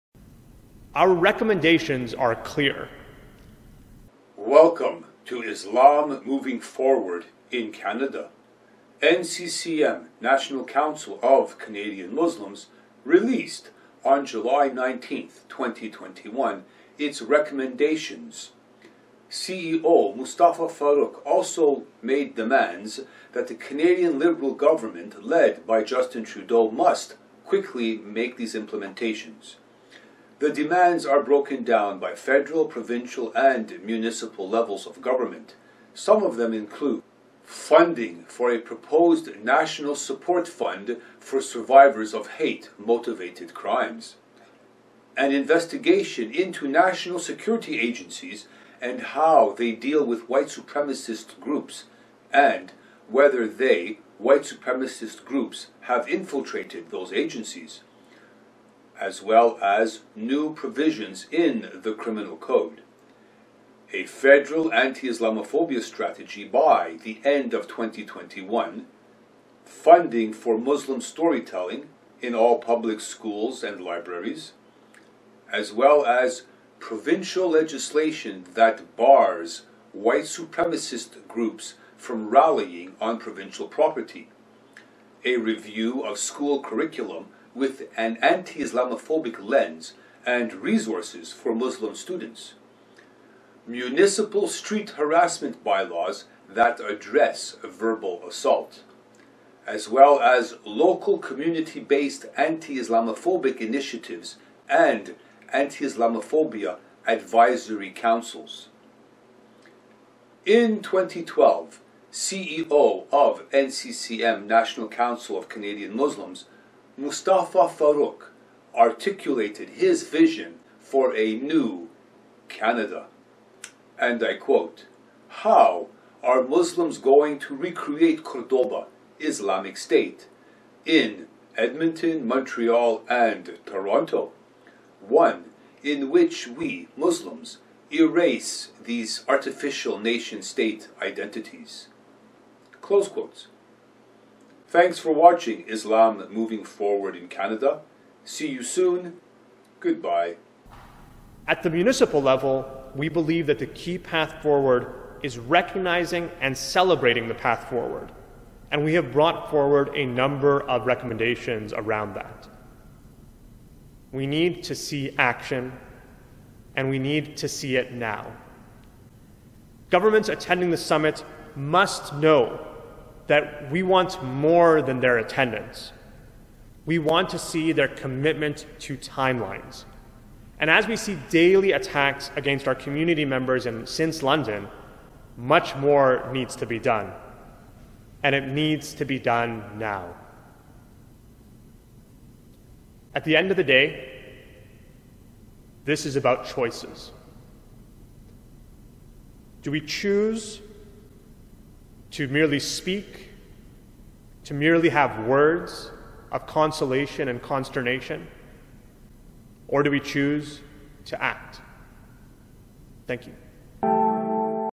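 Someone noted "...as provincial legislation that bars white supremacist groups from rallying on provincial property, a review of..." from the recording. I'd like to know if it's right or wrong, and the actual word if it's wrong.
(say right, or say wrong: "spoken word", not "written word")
right.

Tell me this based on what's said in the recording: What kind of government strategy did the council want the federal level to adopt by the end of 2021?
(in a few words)
Anti-Islamophobia strategy.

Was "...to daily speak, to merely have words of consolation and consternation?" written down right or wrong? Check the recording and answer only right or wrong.
wrong.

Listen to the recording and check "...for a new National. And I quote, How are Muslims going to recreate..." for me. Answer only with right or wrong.
wrong.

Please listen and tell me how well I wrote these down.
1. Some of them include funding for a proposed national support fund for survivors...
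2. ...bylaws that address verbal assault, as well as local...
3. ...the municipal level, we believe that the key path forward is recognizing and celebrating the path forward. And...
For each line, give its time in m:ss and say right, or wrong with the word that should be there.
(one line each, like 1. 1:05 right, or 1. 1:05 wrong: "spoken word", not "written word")
1. 0:35 right
2. 1:35 right
3. 2:31 right.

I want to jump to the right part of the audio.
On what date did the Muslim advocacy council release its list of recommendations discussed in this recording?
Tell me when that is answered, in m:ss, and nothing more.
0:14.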